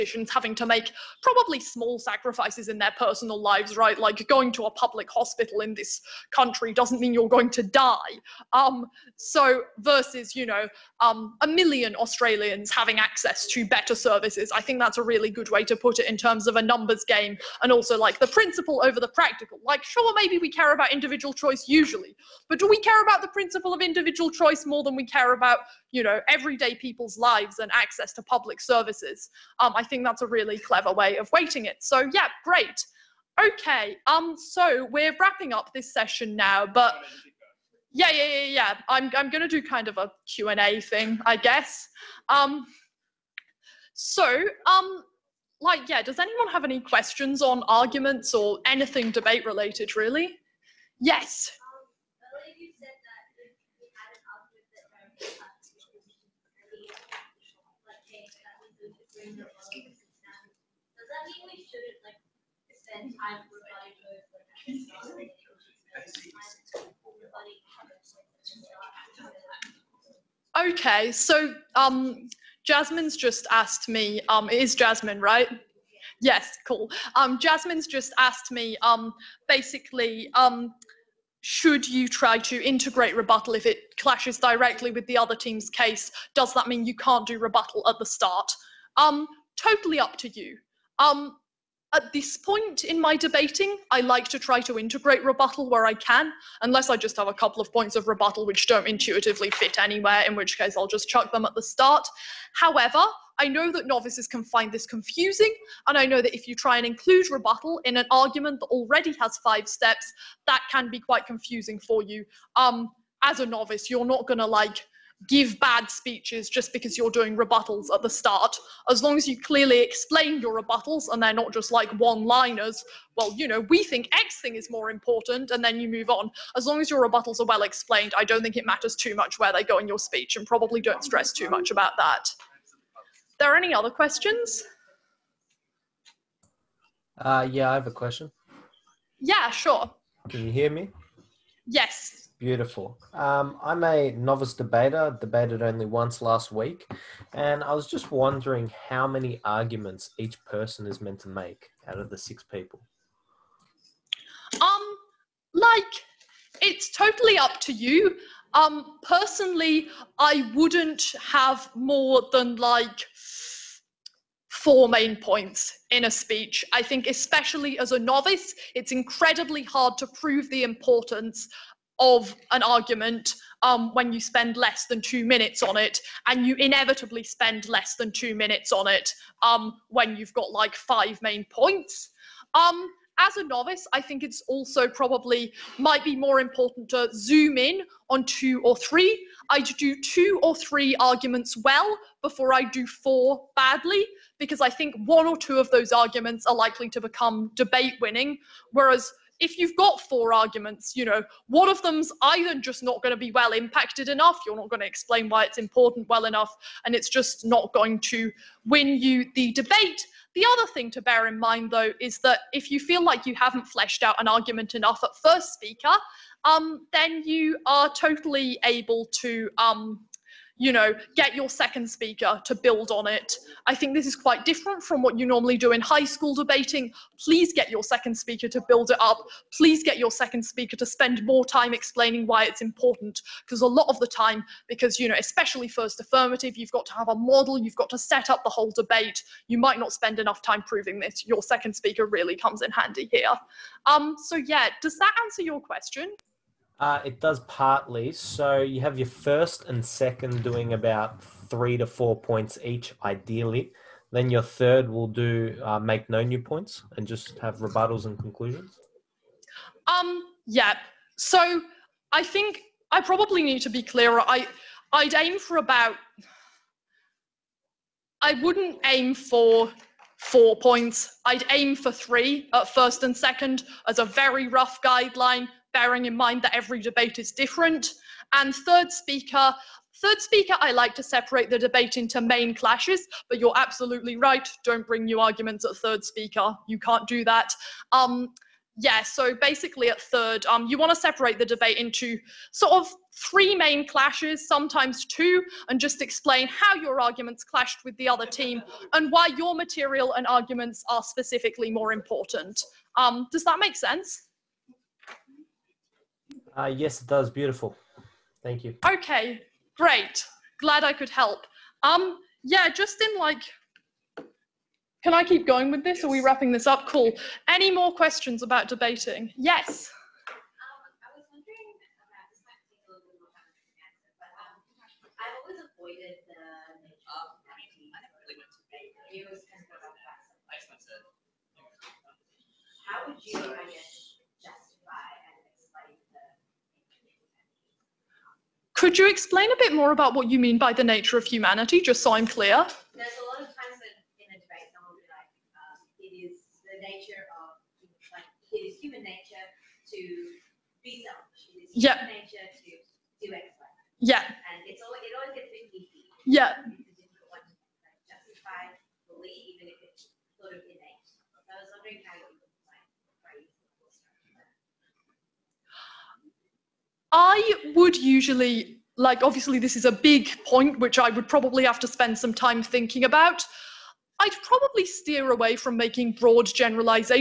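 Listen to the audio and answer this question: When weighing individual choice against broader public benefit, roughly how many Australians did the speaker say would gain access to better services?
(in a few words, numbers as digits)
a million.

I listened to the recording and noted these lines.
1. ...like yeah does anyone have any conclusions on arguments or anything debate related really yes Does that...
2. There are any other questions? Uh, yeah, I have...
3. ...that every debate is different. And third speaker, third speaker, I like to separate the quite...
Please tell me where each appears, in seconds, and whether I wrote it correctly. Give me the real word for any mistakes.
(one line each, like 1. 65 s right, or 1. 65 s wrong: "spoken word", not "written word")
1. 45 s wrong: "questions", not "conclusions"
2. 133 s right
3. 276 s wrong: "debate", not "quite".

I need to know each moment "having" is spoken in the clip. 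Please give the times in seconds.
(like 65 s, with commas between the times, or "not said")
0 s, 12 s.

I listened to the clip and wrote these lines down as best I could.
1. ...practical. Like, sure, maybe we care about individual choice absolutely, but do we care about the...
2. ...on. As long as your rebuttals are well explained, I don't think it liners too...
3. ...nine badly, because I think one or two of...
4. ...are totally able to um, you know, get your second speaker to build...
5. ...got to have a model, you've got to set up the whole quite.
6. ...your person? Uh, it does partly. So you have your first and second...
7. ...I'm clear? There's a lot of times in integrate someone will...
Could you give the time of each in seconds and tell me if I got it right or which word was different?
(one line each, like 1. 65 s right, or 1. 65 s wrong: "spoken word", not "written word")
1. 19 s wrong: "usually", not "absolutely"
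2. 126 s wrong: "matters", not "liners"
3. 192 s wrong: "four", not "nine"
4. 217 s right
5. 236 s wrong: "debate", not "quite"
6. 245 s wrong: "question", not "person"
7. 342 s wrong: "debate", not "integrate".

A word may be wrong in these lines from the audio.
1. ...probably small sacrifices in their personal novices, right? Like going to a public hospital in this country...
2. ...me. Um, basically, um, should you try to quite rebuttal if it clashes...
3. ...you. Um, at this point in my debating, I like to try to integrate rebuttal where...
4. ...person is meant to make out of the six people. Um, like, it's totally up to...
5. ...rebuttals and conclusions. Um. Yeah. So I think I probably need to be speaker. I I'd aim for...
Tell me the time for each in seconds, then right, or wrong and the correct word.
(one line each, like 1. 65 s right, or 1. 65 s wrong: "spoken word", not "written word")
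1. 1 s wrong: "lives", not "novices"
2. 78 s wrong: "integrate", not "quite"
3. 90 s right
4. 150 s right
5. 257 s wrong: "clearer", not "speaker".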